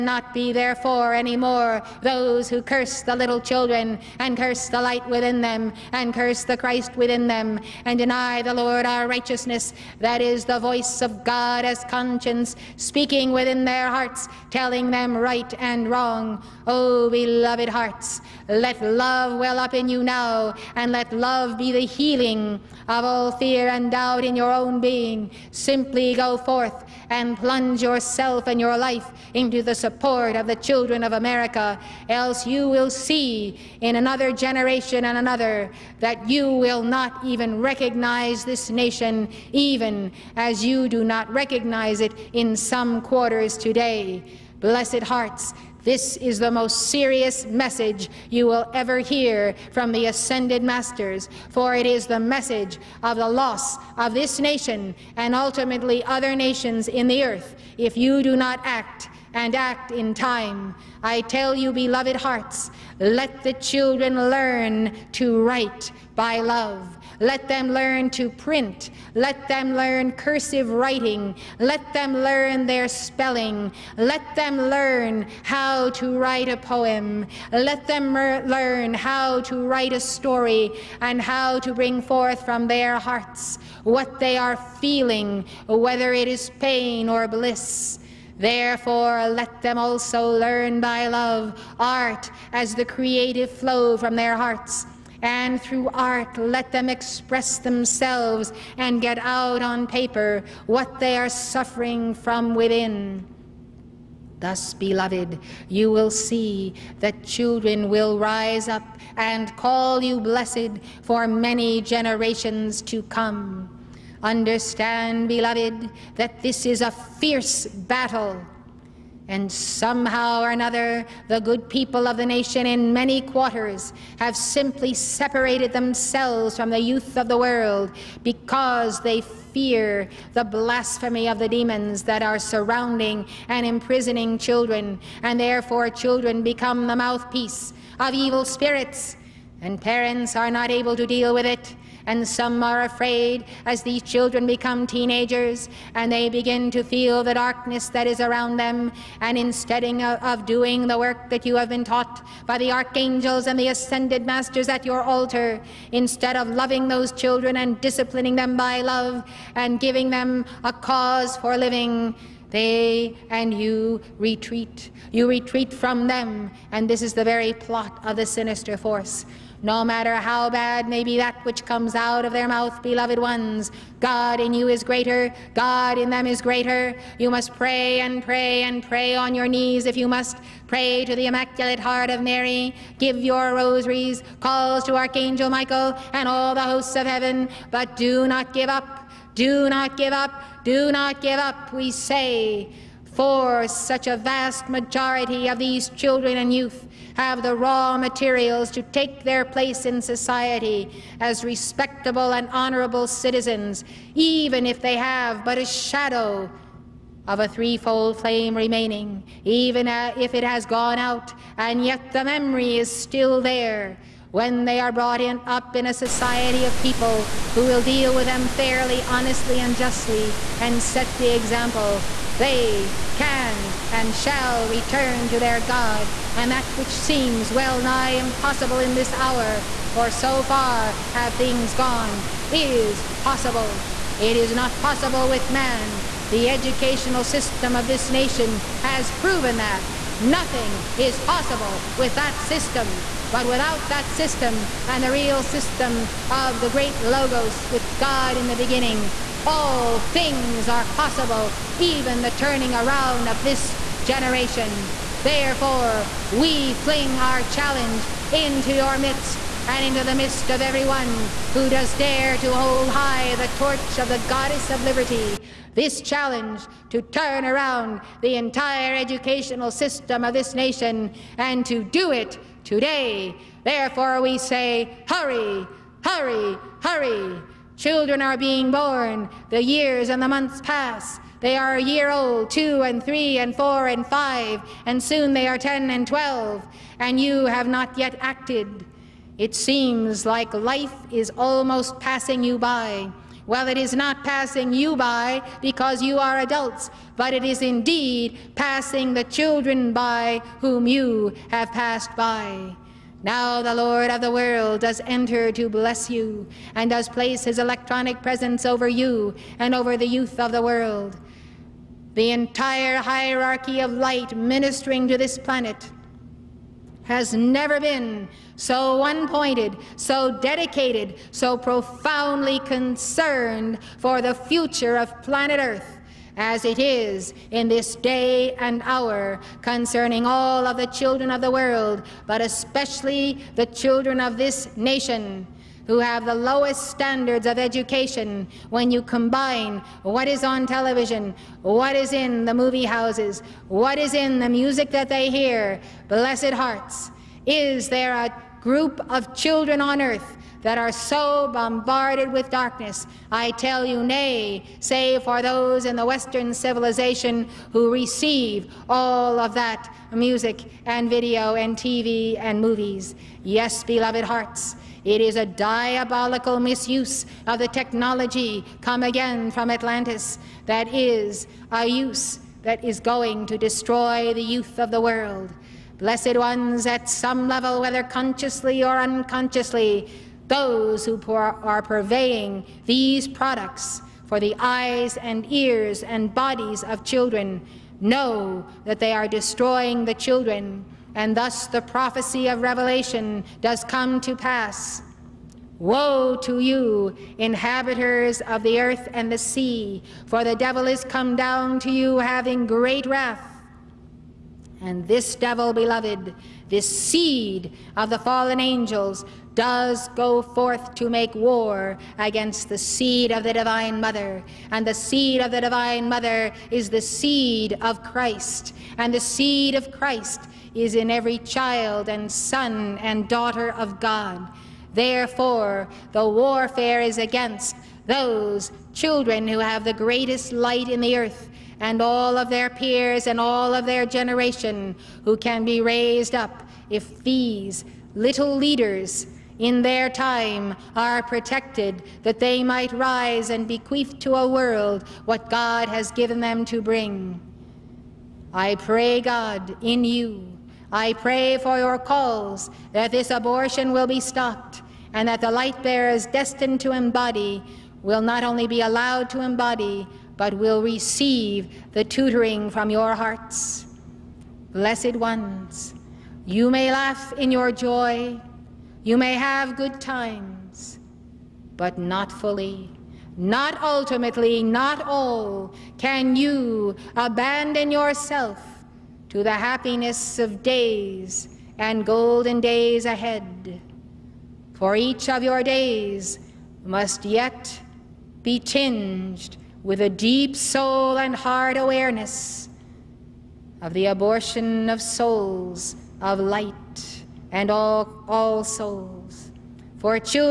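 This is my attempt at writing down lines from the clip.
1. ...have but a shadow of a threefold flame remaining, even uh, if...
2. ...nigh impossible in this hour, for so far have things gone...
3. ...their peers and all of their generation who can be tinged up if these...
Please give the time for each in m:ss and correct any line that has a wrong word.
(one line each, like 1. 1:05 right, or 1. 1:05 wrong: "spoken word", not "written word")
1. 3:24 right
2. 3:47 right
3. 7:12 wrong: "raised", not "tinged".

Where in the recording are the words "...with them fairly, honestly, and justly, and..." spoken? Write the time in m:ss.
3:38.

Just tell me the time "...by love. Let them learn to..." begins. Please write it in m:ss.
1:06.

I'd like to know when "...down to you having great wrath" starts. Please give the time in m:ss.
6:41.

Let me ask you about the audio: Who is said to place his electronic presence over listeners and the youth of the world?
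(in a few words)
The Lord of the world.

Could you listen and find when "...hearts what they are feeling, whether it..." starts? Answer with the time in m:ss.
1:22.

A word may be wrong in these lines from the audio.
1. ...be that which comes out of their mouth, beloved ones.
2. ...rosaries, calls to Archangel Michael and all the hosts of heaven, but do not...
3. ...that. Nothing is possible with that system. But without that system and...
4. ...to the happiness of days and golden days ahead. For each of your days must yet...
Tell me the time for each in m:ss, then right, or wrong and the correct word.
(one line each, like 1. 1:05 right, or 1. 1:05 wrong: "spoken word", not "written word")
1. 2:51 right
2. 3:03 right
3. 3:59 right
4. 7:59 right.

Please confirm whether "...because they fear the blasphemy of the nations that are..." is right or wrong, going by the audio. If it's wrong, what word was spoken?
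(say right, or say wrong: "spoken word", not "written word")
wrong: "demons", not "nations".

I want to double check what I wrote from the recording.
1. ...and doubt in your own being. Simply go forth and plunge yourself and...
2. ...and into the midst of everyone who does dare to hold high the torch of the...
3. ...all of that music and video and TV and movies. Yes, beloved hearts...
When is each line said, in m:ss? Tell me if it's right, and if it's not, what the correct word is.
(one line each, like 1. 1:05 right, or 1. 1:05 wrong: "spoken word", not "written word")
1. 0:23 right
2. 4:19 right
3. 5:58 right.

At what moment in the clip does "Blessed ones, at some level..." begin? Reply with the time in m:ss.
6:15.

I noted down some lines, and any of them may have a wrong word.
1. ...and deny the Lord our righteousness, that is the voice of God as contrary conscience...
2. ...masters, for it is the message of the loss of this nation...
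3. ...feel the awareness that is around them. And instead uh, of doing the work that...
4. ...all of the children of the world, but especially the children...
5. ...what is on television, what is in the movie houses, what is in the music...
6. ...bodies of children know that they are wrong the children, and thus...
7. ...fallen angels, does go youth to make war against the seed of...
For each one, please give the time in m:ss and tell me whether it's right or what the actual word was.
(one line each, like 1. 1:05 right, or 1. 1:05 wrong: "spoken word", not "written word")
1. 0:07 right
2. 0:50 right
3. 2:26 wrong: "darkness", not "awareness"
4. 5:30 right
5. 5:40 right
6. 6:26 wrong: "destroying", not "wrong"
7. 6:48 wrong: "forth", not "youth".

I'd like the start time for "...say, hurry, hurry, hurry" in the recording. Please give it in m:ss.
4:34.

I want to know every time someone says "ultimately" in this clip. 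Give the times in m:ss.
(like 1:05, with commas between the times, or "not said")
0:55, 7:53.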